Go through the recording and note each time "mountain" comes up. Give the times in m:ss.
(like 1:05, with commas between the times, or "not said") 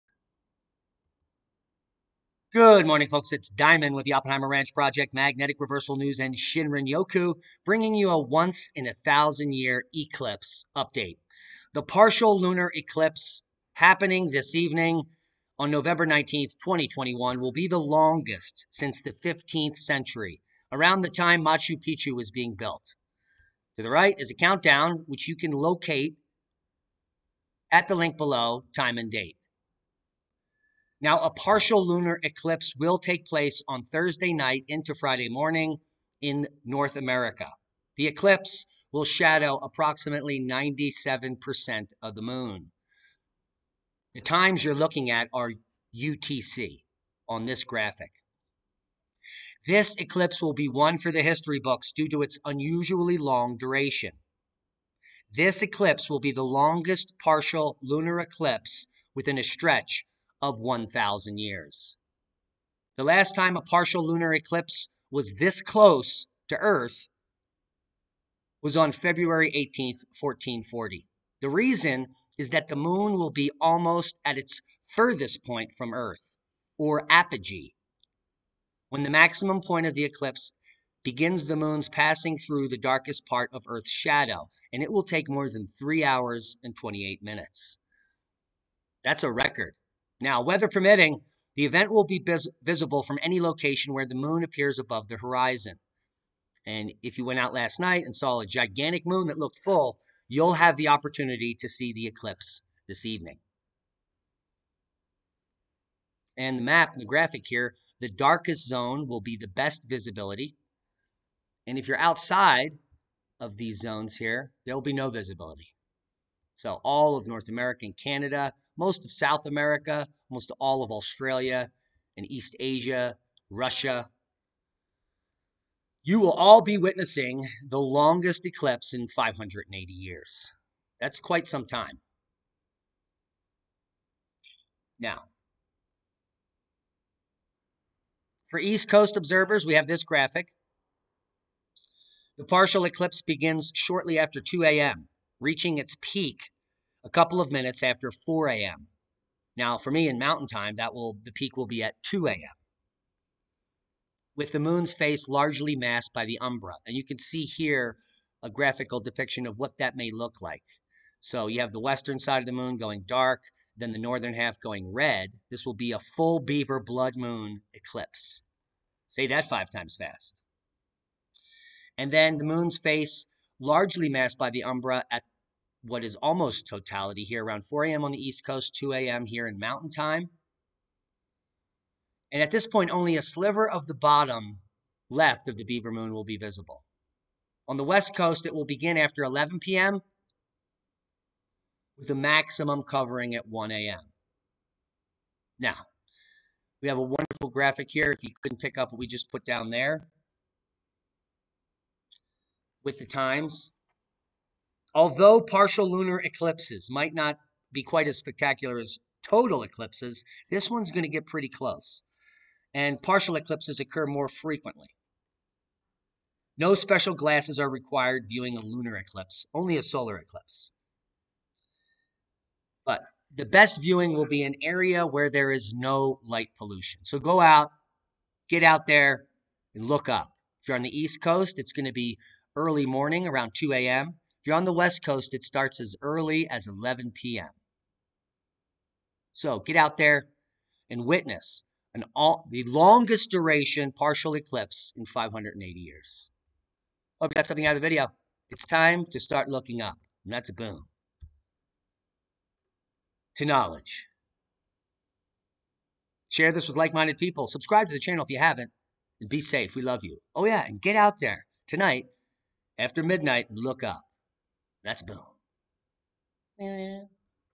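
2:30, 2:59.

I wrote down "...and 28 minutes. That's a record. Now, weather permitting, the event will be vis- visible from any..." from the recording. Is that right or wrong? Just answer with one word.
right.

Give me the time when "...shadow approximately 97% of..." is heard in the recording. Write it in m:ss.
0:39.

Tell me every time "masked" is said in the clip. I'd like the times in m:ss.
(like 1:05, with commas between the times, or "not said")
2:35, 2:54.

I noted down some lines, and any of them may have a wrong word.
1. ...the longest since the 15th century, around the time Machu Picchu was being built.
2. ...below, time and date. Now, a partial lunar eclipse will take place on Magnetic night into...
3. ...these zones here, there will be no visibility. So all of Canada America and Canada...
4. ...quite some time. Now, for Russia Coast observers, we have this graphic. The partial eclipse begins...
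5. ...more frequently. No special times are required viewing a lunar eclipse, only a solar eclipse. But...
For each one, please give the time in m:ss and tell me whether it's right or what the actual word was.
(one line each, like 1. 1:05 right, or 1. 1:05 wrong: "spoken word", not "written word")
1. 0:17 right
2. 0:28 wrong: "Thursday", not "Magnetic"
3. 1:53 wrong: "North", not "Canada"
4. 2:11 wrong: "East", not "Russia"
5. 3:34 wrong: "glasses", not "times".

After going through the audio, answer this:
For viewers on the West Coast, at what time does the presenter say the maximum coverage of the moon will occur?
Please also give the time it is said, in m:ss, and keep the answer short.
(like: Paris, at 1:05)
1 a.m., at 3:13.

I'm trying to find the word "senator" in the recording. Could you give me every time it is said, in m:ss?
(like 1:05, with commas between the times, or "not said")
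not said.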